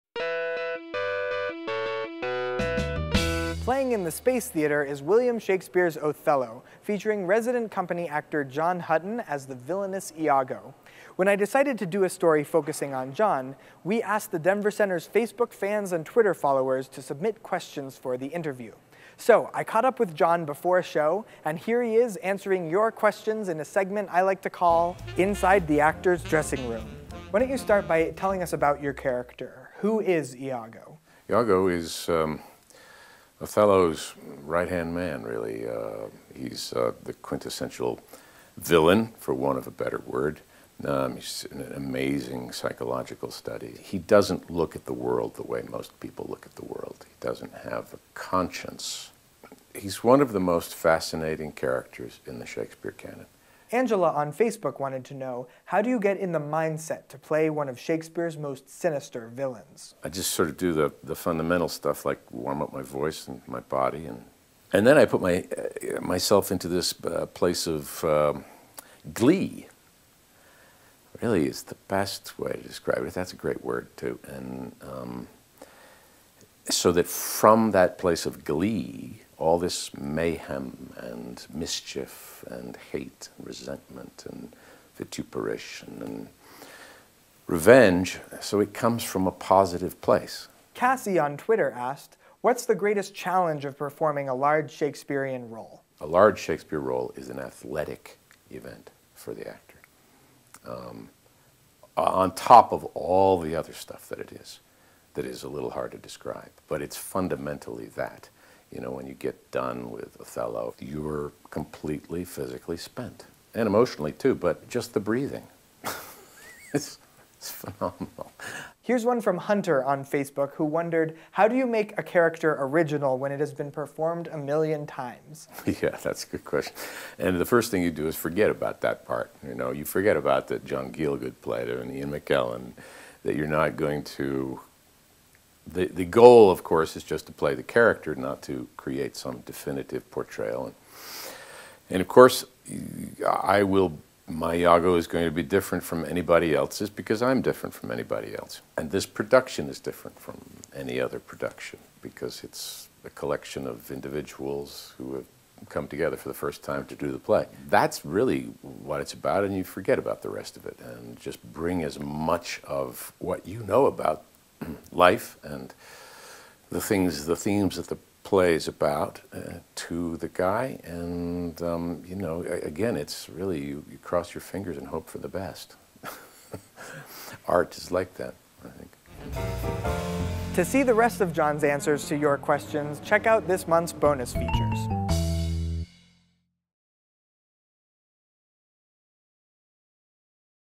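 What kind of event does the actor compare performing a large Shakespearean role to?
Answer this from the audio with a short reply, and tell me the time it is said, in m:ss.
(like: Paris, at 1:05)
an athletic event, at 1:37.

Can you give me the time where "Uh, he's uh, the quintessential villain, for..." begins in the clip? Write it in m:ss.
0:35.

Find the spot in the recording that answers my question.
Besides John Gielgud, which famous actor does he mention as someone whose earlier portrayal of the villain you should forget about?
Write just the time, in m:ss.
2:11.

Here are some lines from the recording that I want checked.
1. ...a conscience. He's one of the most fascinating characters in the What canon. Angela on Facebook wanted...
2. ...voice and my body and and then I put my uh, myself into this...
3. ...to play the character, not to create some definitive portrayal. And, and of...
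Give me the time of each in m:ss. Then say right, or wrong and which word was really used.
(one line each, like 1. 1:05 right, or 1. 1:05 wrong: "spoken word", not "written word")
1. 0:47 wrong: "Shakespeare", not "What"
2. 1:02 right
3. 2:17 right.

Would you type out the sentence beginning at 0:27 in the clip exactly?
Why don't you start by telling us about your character?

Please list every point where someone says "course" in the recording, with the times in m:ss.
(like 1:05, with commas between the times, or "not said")
2:16, 2:22.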